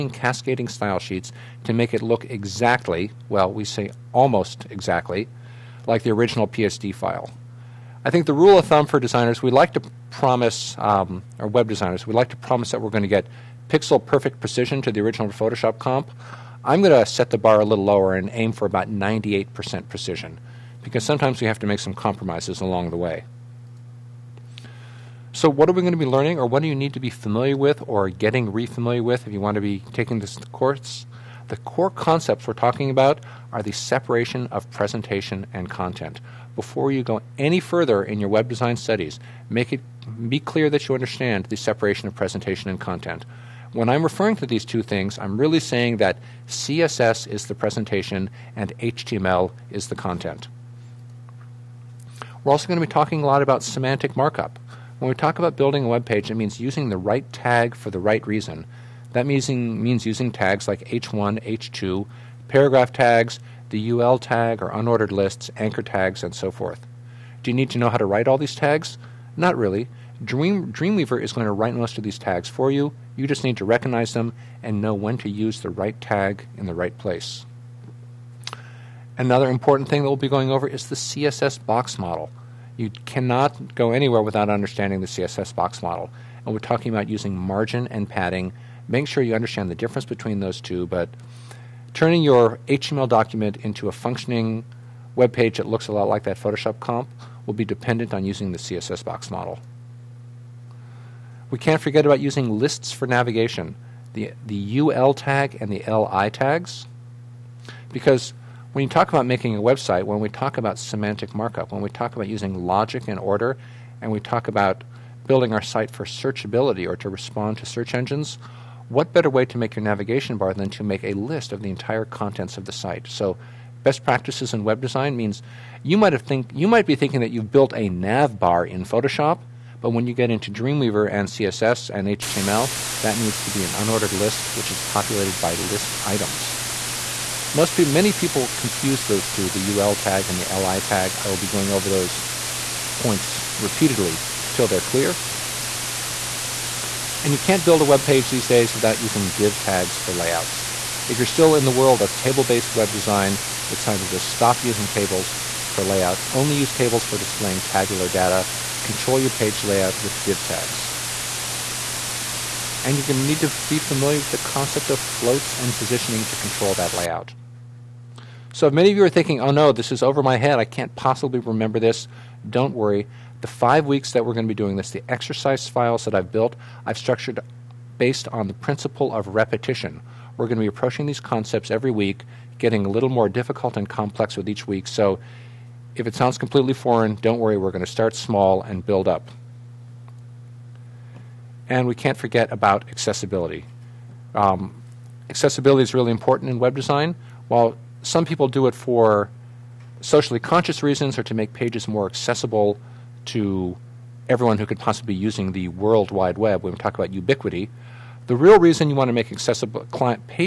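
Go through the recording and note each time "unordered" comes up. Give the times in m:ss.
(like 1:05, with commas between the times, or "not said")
1:04, 2:13.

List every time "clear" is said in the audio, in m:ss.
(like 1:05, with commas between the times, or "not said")
0:40, 2:24.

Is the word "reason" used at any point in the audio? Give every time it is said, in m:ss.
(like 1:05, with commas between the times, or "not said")
0:58, 3:20, 3:28.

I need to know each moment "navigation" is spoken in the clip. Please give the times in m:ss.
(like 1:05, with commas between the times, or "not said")
1:43, 1:59.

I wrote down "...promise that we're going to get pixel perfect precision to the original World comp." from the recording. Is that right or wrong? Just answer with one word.
wrong.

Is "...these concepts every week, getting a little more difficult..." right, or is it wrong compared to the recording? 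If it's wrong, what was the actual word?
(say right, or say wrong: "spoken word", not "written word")
right.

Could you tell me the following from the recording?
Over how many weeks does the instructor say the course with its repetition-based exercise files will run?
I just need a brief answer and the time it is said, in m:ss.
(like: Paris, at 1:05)
5, at 2:53.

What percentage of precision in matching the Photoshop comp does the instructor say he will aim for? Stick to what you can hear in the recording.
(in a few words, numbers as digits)
98%.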